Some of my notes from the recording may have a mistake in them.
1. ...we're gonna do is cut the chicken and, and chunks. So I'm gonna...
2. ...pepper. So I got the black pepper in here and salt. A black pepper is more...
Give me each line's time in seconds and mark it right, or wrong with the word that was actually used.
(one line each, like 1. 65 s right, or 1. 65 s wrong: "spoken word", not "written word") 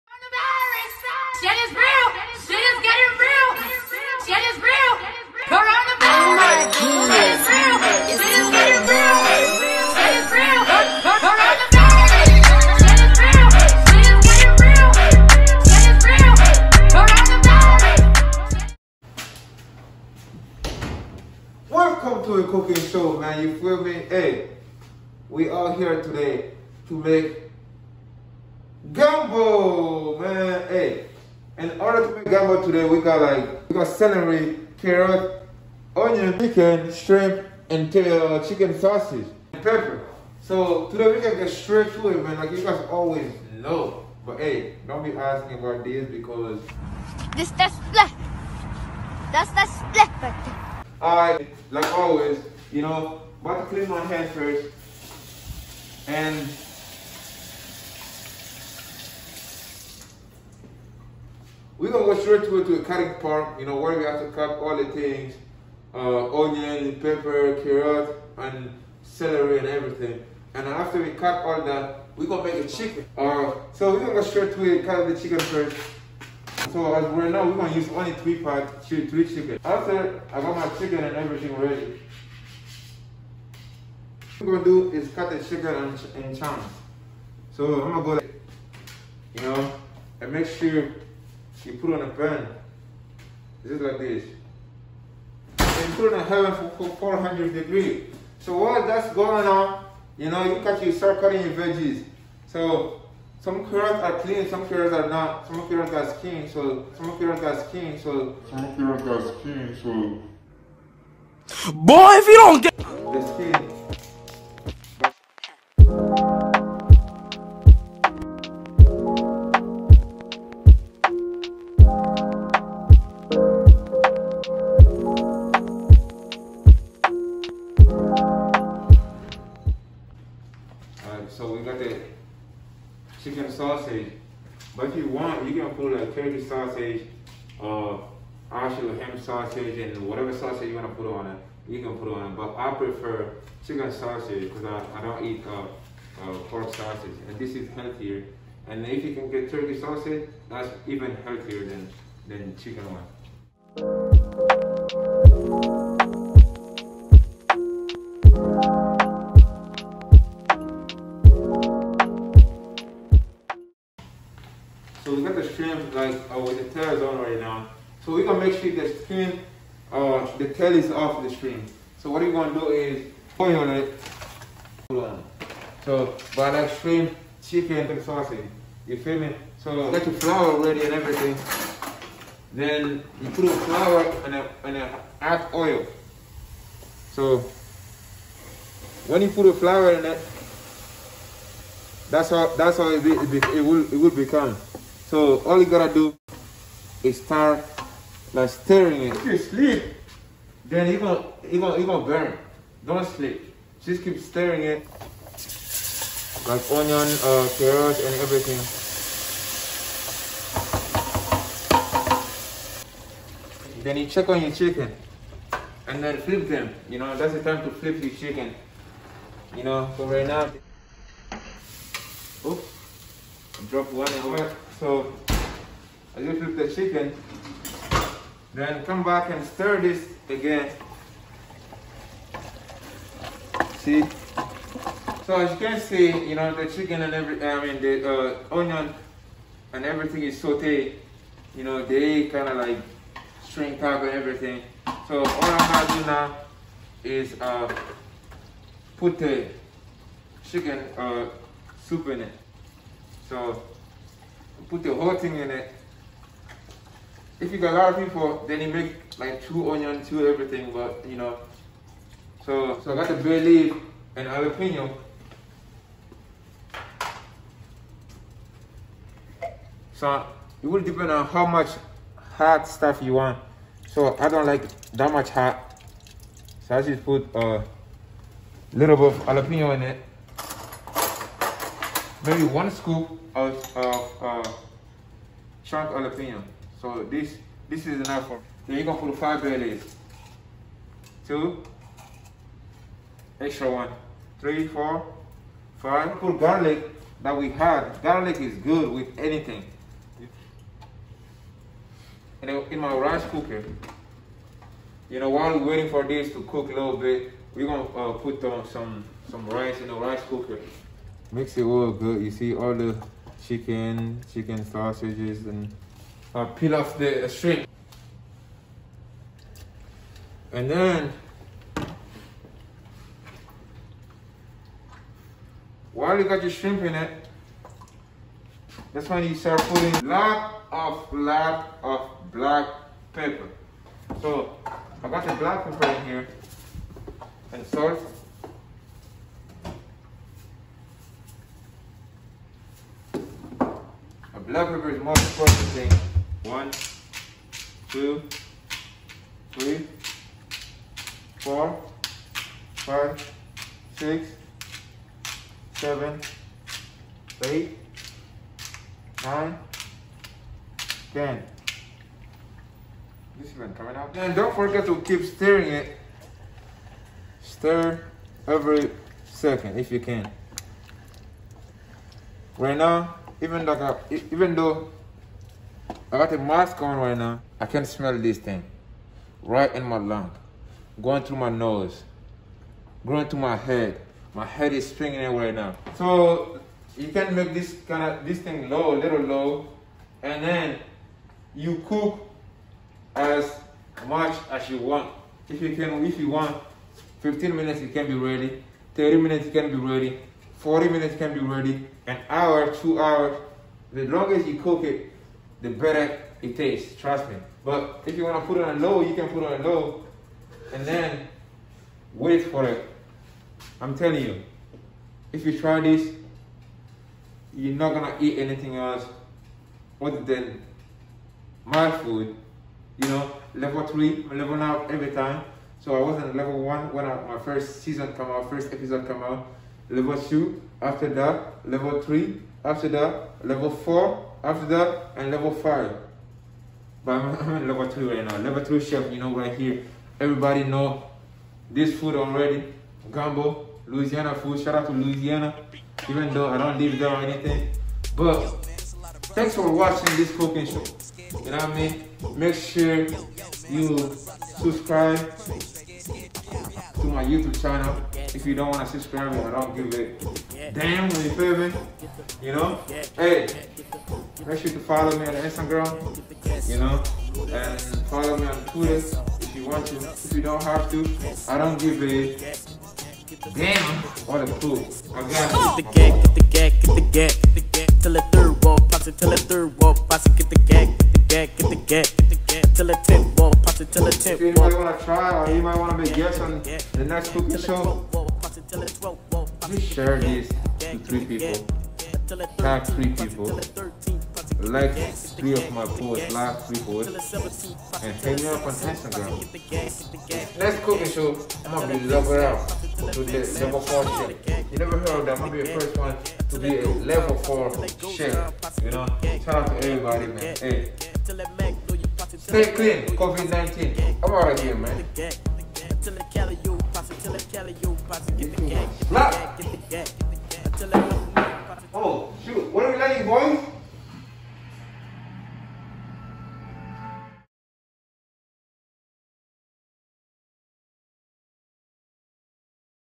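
1. 84 s right
2. 333 s right.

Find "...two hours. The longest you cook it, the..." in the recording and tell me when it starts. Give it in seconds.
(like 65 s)
402 s.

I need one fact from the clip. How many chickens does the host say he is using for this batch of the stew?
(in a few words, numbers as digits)
3.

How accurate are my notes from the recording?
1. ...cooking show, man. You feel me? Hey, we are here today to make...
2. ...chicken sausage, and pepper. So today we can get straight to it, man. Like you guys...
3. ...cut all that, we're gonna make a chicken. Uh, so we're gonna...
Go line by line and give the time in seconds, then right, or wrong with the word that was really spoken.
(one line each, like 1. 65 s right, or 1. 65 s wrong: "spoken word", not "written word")
1. 22 s right
2. 38 s right
3. 71 s right.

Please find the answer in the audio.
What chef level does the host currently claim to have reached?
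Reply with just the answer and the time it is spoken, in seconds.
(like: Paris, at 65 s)
Level 3, at 438 s.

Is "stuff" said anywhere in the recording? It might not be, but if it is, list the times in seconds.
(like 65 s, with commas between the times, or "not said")
272 s.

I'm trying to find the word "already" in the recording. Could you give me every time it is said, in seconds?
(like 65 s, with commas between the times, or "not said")
442 s.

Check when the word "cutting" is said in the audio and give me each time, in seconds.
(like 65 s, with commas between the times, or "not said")
62 s, 101 s.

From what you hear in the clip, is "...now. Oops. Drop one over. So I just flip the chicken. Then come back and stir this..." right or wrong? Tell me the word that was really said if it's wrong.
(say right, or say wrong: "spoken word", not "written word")
right.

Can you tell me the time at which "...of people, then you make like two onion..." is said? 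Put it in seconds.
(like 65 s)
257 s.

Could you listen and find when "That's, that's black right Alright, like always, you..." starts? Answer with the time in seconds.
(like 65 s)
49 s.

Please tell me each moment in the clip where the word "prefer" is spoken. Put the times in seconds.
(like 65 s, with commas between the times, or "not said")
142 s.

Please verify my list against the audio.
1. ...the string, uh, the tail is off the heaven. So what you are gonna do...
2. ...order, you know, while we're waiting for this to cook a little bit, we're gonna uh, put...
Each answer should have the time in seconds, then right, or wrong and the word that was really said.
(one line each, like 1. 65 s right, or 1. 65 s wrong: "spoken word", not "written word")
1. 168 s wrong: "screen", not "heaven"
2. 303 s wrong: "cooker", not "order".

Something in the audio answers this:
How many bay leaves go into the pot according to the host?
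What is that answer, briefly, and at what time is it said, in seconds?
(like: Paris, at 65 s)
5, at 289 s.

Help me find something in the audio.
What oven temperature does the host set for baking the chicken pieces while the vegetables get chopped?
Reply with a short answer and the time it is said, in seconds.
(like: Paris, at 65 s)
400 degrees, at 96 s.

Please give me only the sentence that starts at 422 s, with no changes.
You know, level three, I'm leveling out every time.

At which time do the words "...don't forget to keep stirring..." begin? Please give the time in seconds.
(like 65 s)
364 s.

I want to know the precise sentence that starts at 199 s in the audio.
If you sleep, then you gonna, you gonna, you gonna burn.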